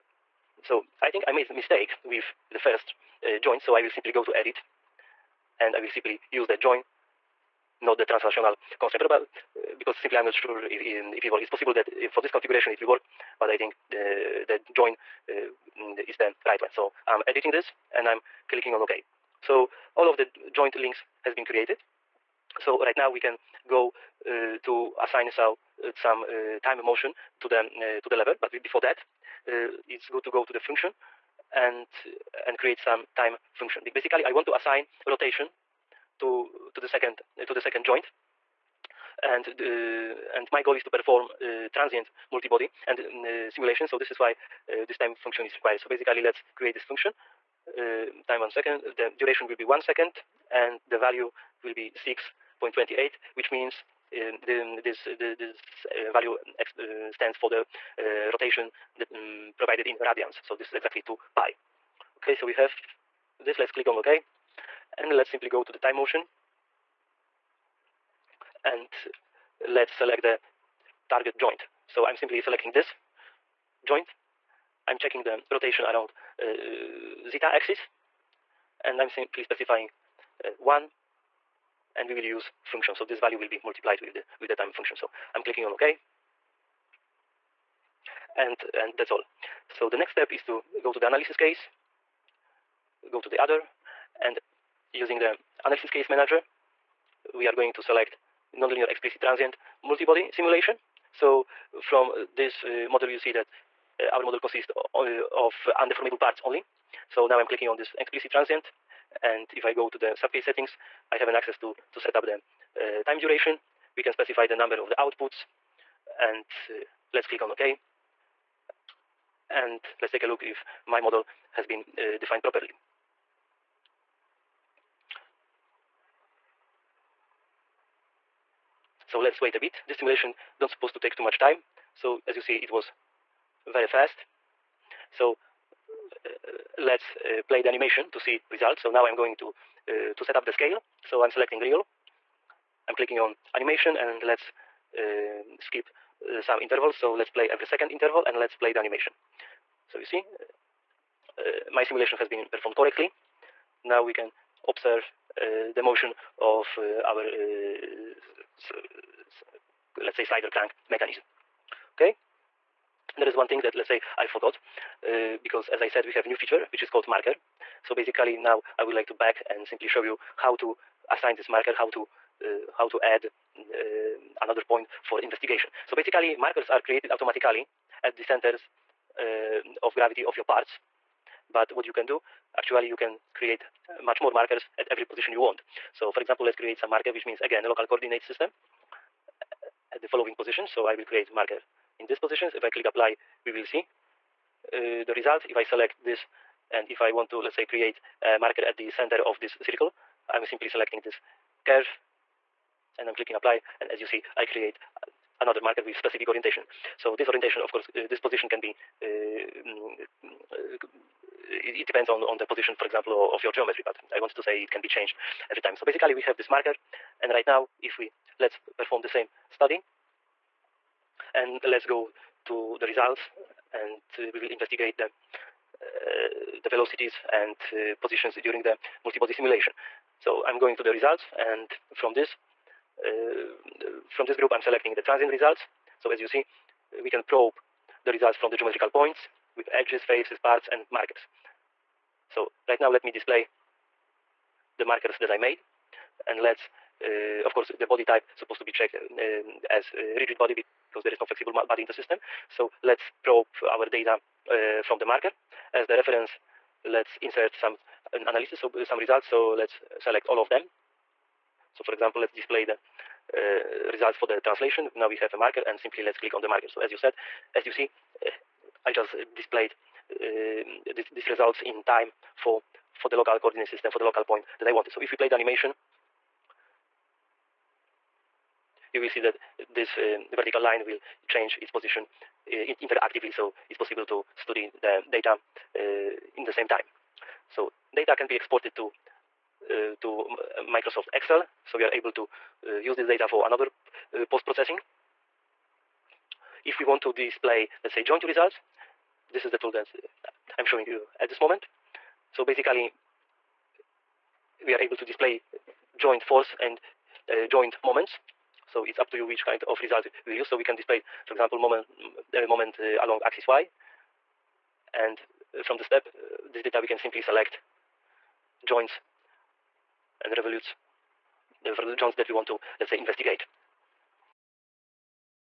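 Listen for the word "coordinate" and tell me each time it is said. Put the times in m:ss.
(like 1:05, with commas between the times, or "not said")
3:07, 4:33.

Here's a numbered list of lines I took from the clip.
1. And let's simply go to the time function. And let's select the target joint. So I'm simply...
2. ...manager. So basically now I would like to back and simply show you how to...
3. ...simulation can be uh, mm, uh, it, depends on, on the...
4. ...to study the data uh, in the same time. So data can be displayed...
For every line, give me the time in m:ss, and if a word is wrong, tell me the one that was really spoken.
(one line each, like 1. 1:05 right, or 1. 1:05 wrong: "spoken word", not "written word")
1. 1:04 wrong: "motion", not "function"
2. 2:47 wrong: "marker", not "manager"
3. 3:28 wrong: "position", not "simulation"
4. 4:44 wrong: "exported", not "displayed".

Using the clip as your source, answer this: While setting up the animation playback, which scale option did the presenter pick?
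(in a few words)
real.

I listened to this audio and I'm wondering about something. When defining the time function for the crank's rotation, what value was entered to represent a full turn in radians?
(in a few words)
6.28.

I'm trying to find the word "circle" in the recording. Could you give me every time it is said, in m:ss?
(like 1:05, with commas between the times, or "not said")
3:19.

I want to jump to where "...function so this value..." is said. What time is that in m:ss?
1:22.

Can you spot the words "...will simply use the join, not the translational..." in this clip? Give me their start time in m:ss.
0:05.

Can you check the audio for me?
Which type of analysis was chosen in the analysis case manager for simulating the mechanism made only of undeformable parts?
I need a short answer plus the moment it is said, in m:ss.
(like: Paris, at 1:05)
nonlinear explicit transient multibody, at 1:38.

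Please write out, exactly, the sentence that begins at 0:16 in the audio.
So I'm editing this and I'm clicking on OK.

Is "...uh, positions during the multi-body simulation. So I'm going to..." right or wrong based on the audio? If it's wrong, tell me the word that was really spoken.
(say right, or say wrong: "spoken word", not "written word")
right.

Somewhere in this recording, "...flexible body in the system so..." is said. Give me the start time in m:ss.
4:11.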